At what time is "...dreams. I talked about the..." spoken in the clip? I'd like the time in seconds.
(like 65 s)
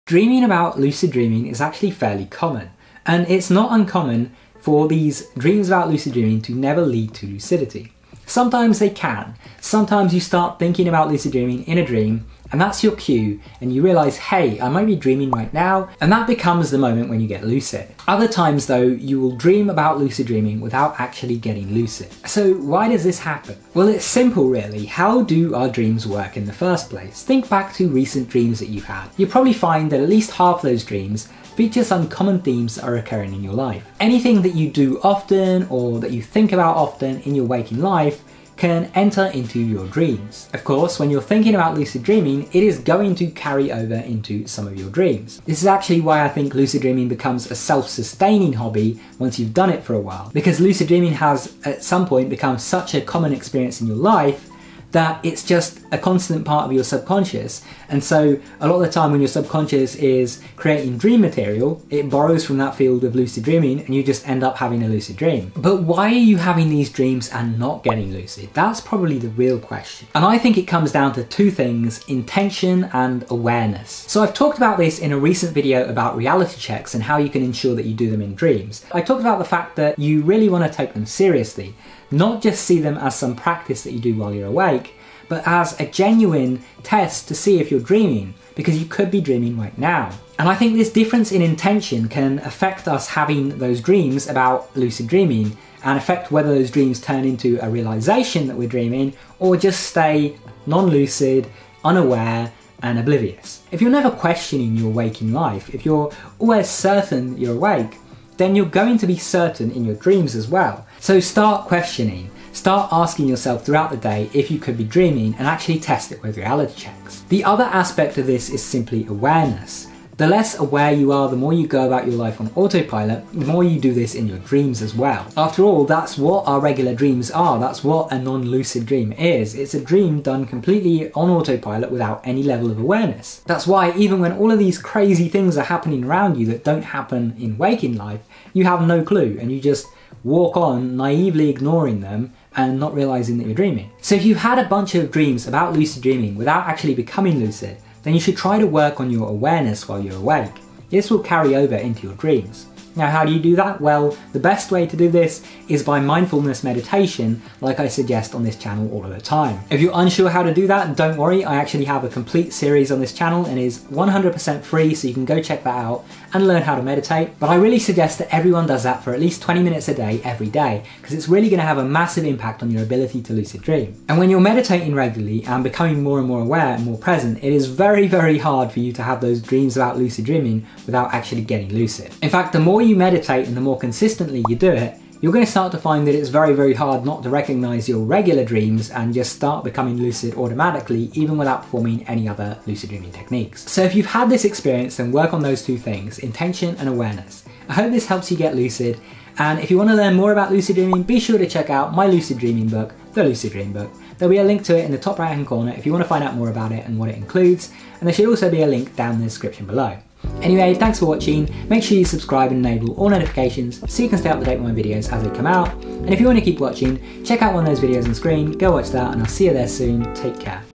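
78 s.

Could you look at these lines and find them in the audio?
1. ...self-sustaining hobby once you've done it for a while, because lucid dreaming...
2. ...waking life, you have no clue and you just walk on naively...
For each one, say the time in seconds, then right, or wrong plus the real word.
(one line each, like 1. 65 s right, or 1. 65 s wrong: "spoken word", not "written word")
1. 47 s right
2. 137 s right.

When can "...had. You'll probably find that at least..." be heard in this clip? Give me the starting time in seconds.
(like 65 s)
28 s.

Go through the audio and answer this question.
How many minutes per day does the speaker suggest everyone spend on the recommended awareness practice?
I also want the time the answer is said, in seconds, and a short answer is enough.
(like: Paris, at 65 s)
20, at 169 s.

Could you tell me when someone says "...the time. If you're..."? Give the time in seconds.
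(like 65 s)
159 s.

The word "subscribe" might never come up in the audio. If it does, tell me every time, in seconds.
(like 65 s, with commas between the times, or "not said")
212 s.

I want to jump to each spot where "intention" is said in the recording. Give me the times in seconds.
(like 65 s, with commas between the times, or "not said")
72 s, 91 s, 196 s.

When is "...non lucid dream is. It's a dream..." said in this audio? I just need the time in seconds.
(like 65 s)
128 s.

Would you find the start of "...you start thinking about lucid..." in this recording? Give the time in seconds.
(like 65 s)
10 s.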